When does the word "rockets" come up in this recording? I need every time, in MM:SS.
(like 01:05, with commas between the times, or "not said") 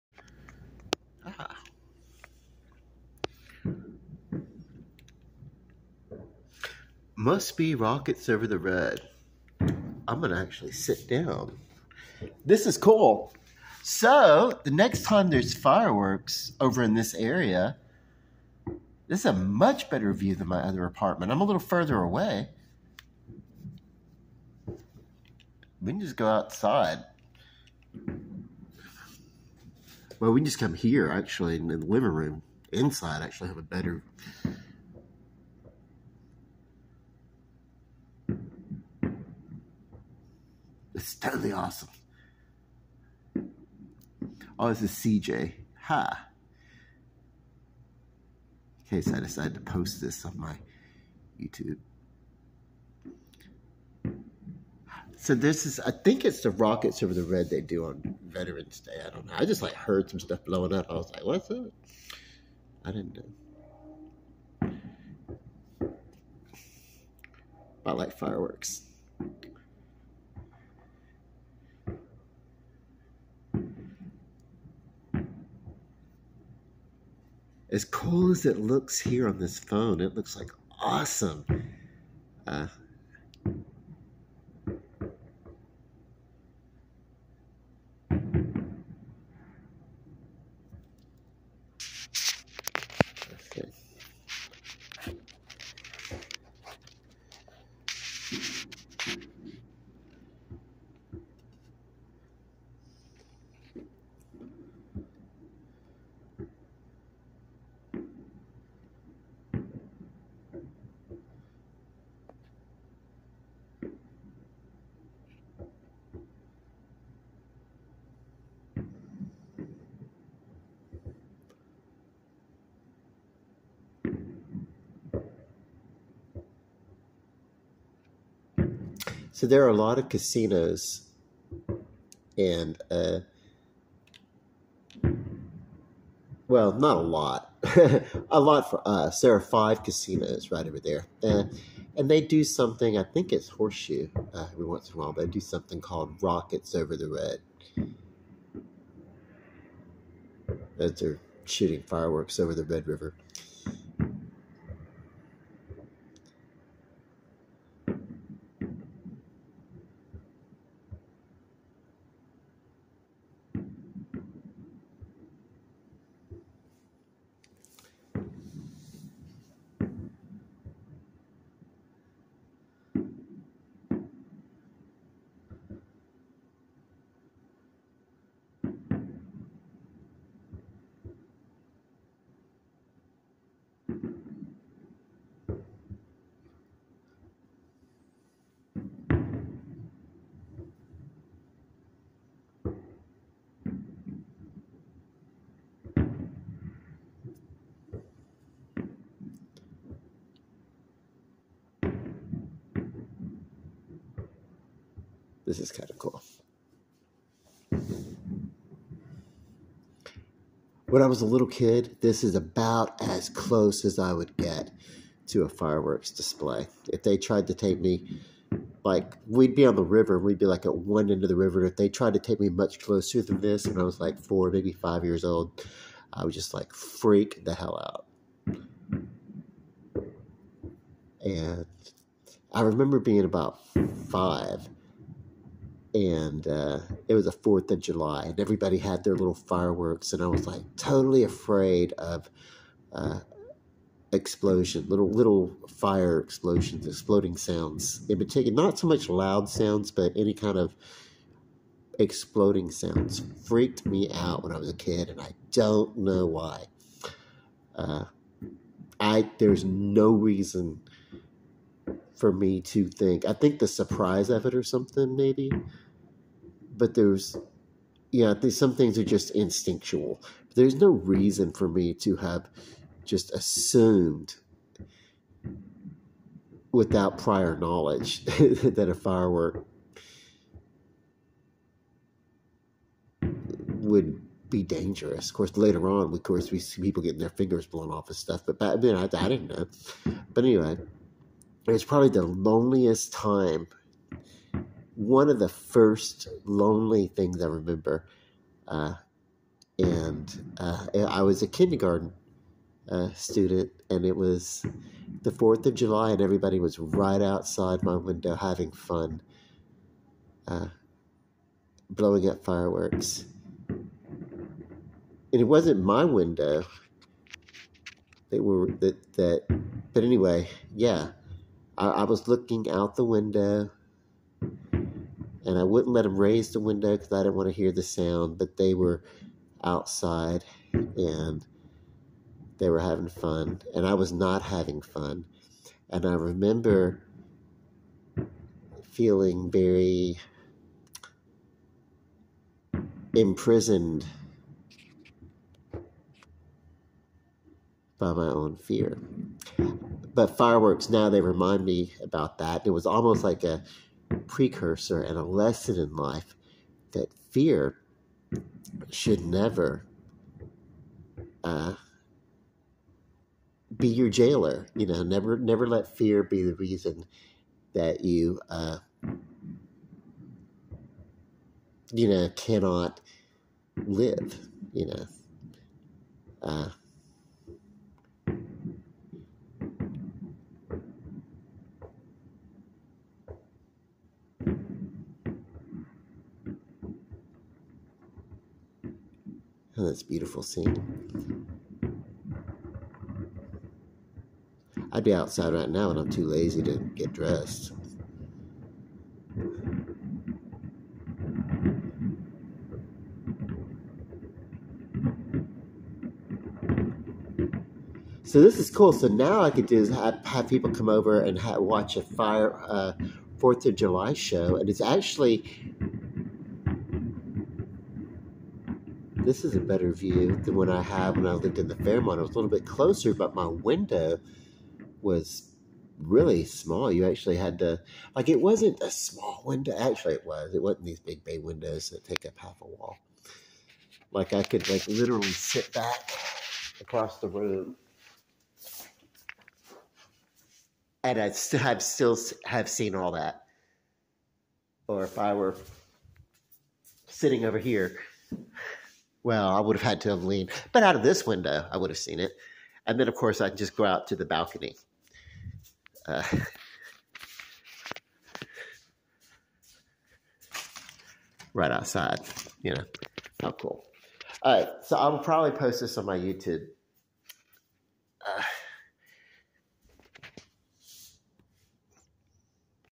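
00:07, 00:56, 02:26.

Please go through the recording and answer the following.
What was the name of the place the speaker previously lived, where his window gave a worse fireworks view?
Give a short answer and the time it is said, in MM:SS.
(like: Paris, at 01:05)
Fairmont, at 07:01.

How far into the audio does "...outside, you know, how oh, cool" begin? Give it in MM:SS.
07:41.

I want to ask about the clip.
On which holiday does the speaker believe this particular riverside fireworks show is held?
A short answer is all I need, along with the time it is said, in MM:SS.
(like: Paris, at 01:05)
Veterans Day, at 00:58.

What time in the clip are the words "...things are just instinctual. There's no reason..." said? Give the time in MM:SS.
04:28.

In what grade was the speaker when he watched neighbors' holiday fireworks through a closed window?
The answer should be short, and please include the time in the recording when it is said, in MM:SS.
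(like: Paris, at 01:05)
Kindergarten, at 05:01.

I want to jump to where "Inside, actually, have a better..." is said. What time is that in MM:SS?
00:32.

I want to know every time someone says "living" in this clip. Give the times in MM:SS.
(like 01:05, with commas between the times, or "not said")
00:31.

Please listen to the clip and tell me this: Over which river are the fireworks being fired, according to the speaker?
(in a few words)
Red River.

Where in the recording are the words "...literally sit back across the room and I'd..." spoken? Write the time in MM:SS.
07:14.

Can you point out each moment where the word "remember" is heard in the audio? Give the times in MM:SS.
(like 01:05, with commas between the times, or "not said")
03:52, 04:57, 05:36.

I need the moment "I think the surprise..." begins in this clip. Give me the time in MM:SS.
04:23.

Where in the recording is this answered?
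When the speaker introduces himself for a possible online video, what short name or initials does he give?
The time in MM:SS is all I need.
00:44.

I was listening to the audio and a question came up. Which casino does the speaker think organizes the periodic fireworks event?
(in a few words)
Horseshoe.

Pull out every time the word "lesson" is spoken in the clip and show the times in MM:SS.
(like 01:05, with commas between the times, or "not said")
05:55.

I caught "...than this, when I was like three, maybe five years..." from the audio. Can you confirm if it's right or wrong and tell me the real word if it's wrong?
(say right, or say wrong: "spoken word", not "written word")
wrong: "four", not "three".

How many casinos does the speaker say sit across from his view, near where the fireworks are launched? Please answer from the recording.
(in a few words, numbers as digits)
5.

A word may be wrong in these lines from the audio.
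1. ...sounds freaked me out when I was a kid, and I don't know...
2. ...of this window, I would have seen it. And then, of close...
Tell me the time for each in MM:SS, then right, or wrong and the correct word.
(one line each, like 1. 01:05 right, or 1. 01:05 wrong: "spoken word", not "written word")
1. 04:12 right
2. 07:30 wrong: "course", not "close".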